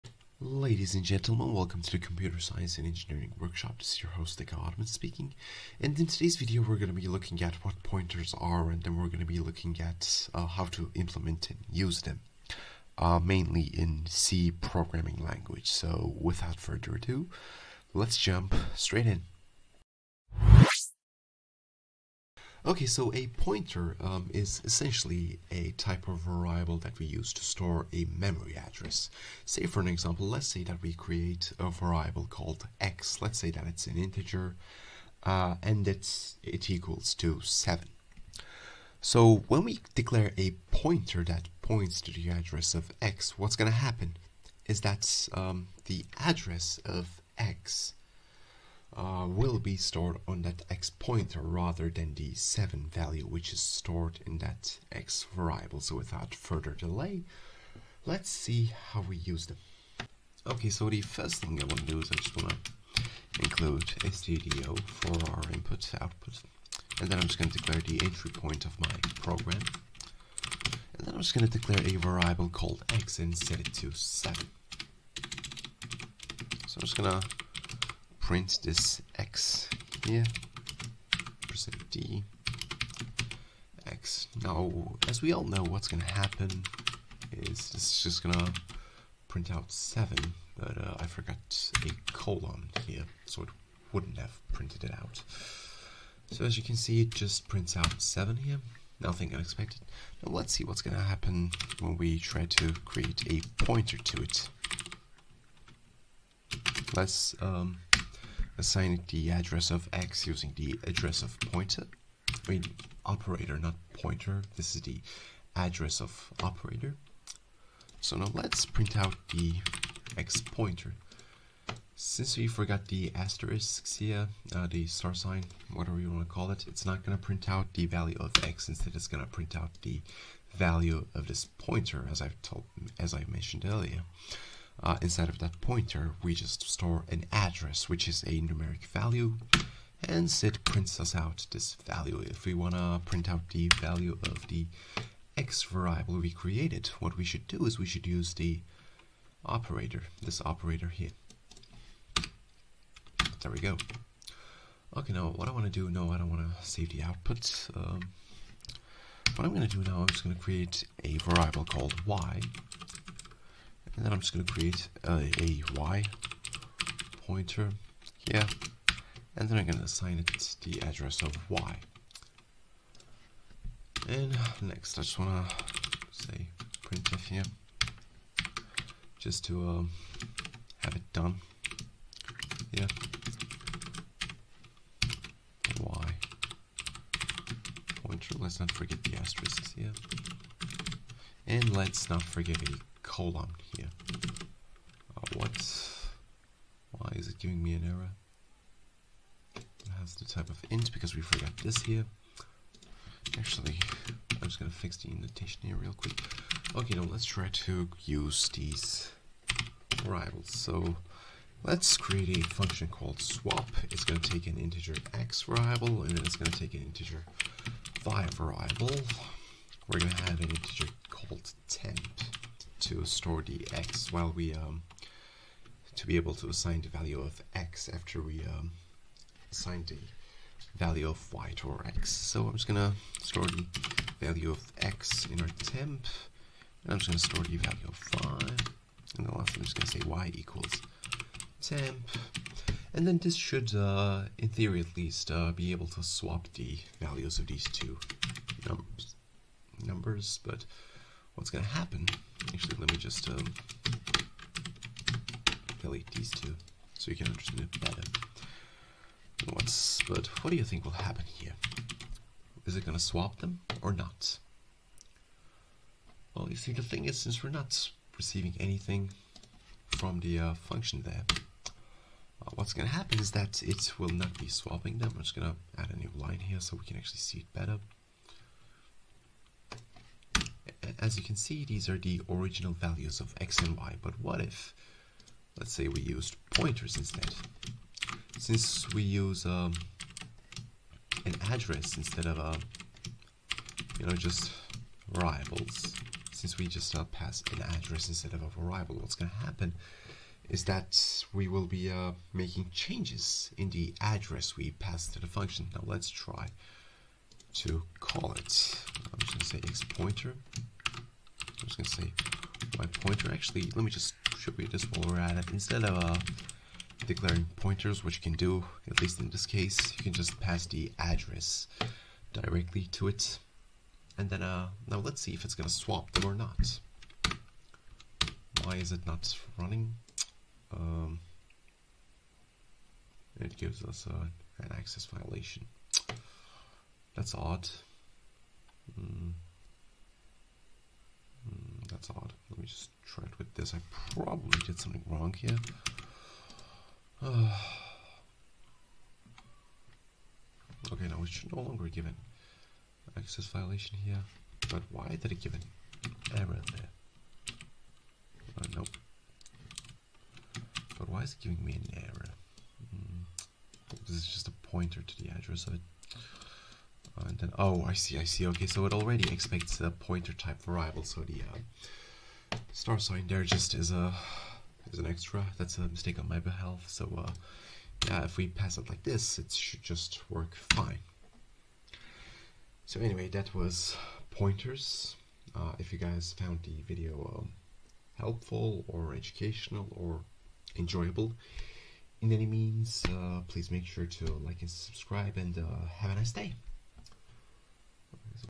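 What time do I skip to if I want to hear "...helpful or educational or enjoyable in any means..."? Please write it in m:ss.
6:28.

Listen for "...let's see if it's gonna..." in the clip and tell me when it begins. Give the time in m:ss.
5:24.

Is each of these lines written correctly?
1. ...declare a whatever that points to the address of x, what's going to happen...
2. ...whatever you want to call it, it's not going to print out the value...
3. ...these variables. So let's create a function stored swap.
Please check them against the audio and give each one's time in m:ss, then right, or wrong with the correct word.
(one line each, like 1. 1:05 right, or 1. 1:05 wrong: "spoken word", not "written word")
1. 0:39 wrong: "pointer", not "whatever"
2. 2:05 right
3. 3:28 wrong: "called", not "stored".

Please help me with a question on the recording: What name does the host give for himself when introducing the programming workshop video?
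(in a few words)
Deka Ottoman.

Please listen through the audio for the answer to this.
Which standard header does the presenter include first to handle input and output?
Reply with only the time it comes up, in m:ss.
1:03.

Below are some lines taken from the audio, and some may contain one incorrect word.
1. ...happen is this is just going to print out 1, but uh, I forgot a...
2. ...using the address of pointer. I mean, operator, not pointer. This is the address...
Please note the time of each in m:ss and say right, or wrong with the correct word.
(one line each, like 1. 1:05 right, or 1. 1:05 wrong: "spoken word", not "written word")
1. 1:26 wrong: "7", not "1"
2. 1:50 right.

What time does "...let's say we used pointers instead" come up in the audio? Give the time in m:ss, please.
4:45.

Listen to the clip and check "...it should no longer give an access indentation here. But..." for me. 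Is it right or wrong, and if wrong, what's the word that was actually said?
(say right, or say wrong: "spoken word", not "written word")
wrong: "violation", not "indentation".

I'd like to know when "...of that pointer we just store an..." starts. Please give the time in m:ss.
2:15.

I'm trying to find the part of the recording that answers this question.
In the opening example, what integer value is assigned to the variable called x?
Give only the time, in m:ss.
0:36.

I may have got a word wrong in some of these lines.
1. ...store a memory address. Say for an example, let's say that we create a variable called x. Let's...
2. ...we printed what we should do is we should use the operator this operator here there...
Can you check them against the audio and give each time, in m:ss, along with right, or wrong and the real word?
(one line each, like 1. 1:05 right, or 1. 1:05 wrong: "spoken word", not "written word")
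1. 0:27 right
2. 2:26 wrong: "created", not "printed".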